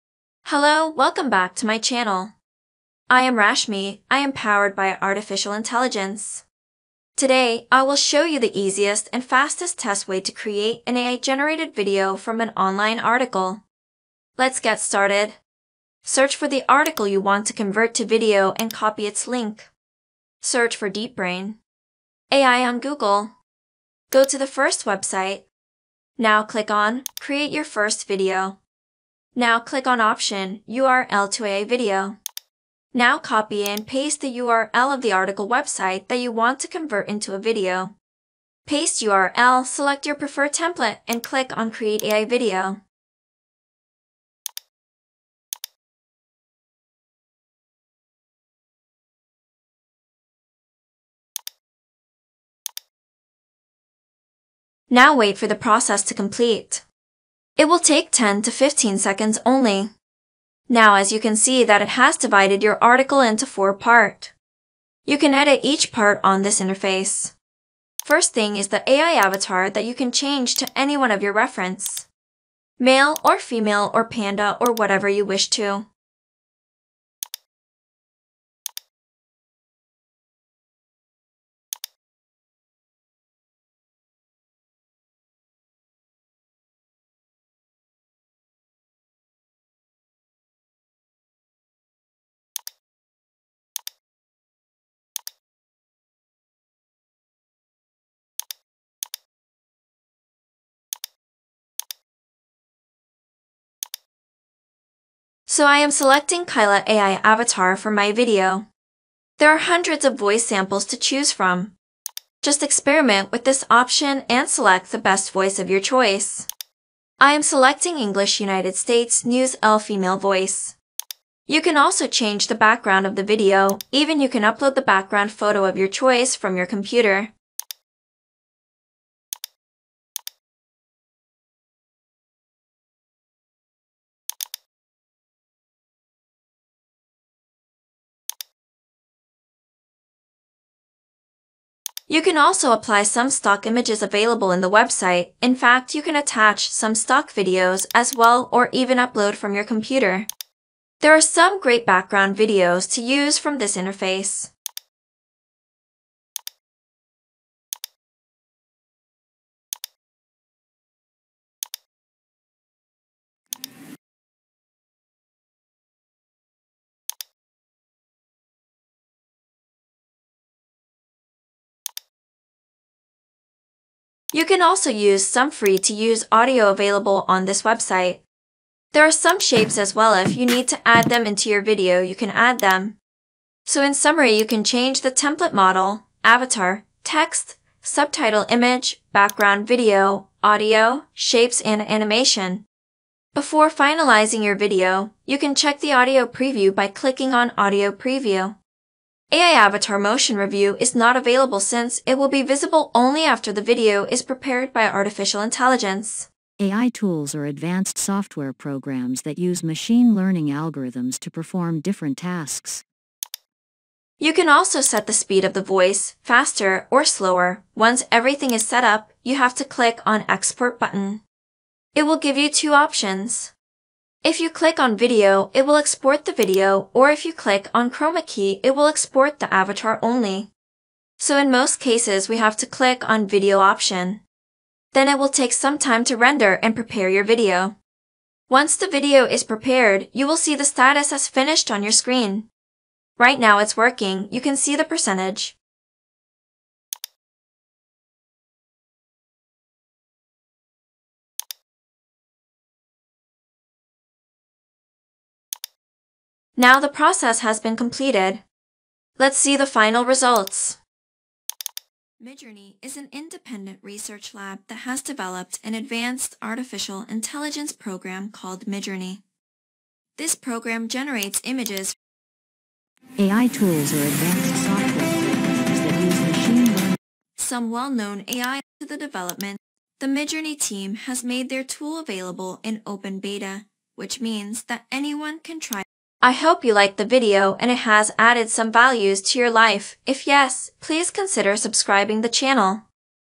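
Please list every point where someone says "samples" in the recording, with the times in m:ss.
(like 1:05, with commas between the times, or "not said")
1:50.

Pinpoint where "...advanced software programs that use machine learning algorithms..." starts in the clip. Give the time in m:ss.
3:27.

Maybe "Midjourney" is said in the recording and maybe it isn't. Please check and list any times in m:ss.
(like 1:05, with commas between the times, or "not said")
4:22, 4:28, 4:40.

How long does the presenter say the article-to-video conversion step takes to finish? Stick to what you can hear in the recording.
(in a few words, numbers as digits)
10 to 15 seconds.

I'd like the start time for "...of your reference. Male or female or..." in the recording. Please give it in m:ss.
1:11.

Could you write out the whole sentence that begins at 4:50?
If yes, please consider subscribing the channel.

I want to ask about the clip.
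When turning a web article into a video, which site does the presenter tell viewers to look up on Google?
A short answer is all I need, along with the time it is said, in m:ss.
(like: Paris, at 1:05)
DeepBrain AI, at 0:20.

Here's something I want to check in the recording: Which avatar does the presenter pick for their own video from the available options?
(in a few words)
Kyla.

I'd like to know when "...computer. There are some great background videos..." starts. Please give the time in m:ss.
2:29.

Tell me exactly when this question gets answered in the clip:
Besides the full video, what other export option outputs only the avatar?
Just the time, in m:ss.
3:47.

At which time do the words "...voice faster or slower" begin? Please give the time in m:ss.
3:35.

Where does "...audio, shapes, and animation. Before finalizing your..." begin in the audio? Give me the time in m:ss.
3:10.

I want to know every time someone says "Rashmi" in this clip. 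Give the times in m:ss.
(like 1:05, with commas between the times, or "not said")
0:03.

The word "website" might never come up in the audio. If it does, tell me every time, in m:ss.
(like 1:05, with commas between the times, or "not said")
0:24, 0:35, 2:24, 2:57.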